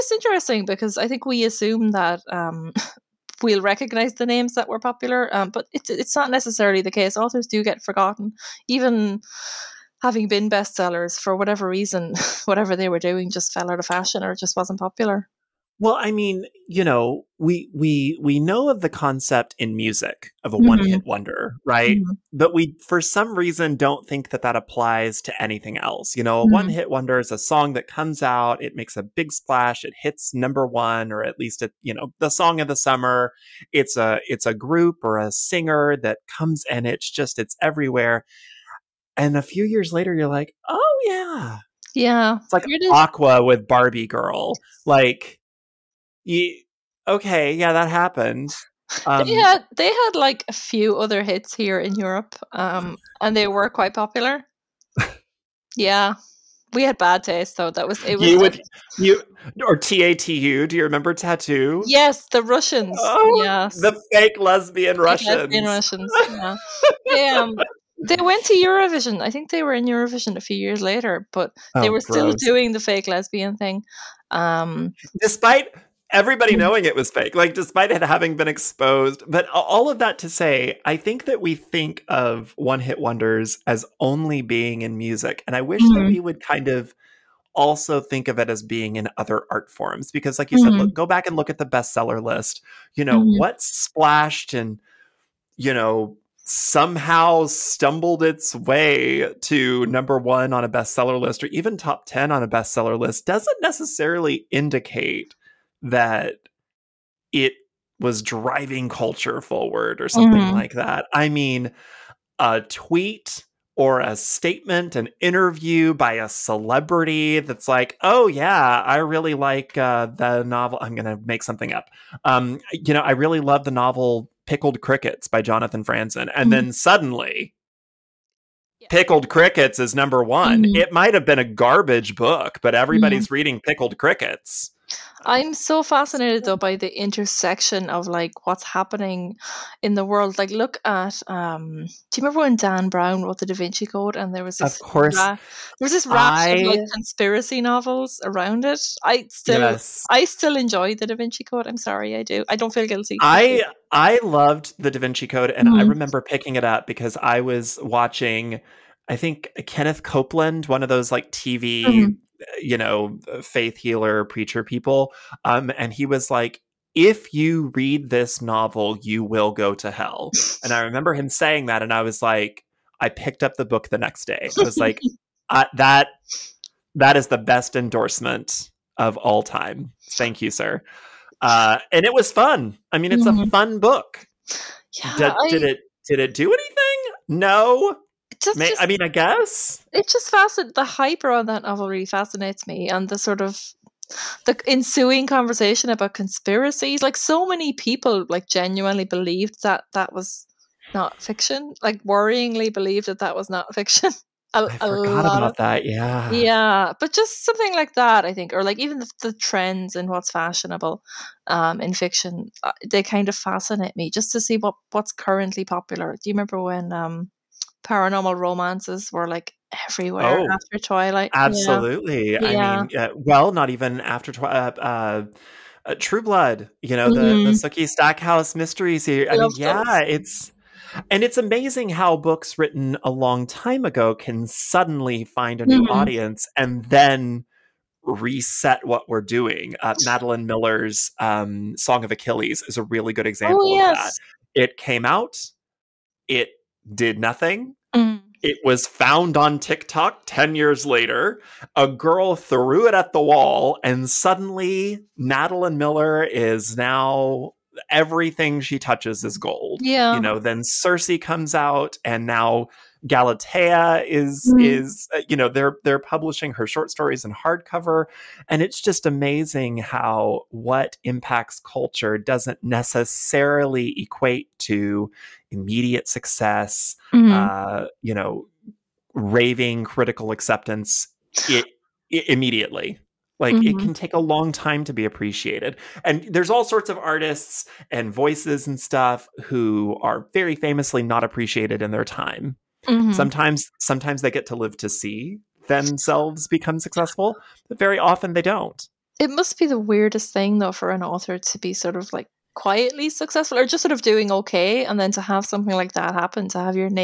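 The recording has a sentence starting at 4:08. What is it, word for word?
It was found on TikTok 10 years later.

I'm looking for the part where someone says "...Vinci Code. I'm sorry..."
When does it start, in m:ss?
2:31.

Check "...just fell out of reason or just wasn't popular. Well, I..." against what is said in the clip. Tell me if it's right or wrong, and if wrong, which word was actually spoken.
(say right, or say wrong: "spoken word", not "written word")
wrong: "fashion", not "reason".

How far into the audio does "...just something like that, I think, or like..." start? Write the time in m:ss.
3:27.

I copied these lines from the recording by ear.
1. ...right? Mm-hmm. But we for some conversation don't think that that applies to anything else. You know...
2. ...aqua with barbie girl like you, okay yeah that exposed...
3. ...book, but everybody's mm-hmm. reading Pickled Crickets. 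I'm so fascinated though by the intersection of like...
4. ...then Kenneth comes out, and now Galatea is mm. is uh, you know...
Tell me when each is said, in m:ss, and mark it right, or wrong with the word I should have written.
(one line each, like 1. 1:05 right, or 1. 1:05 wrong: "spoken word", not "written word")
1. 0:21 wrong: "reason", not "conversation"
2. 0:42 wrong: "happened", not "exposed"
3. 2:12 right
4. 4:20 wrong: "Circe", not "Kenneth".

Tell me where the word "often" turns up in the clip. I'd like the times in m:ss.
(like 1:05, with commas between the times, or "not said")
4:57.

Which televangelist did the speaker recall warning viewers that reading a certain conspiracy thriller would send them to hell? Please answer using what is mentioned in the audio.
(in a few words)
Kenneth Copeland.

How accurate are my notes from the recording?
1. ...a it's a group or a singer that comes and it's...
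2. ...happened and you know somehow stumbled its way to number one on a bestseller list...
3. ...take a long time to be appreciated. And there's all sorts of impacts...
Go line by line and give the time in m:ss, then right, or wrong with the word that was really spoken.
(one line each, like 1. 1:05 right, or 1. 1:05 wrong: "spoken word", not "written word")
1. 0:33 right
2. 1:33 wrong: "splashed", not "happened"
3. 4:43 wrong: "artists", not "impacts".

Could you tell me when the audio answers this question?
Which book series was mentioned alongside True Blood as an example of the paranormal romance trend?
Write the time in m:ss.
3:47.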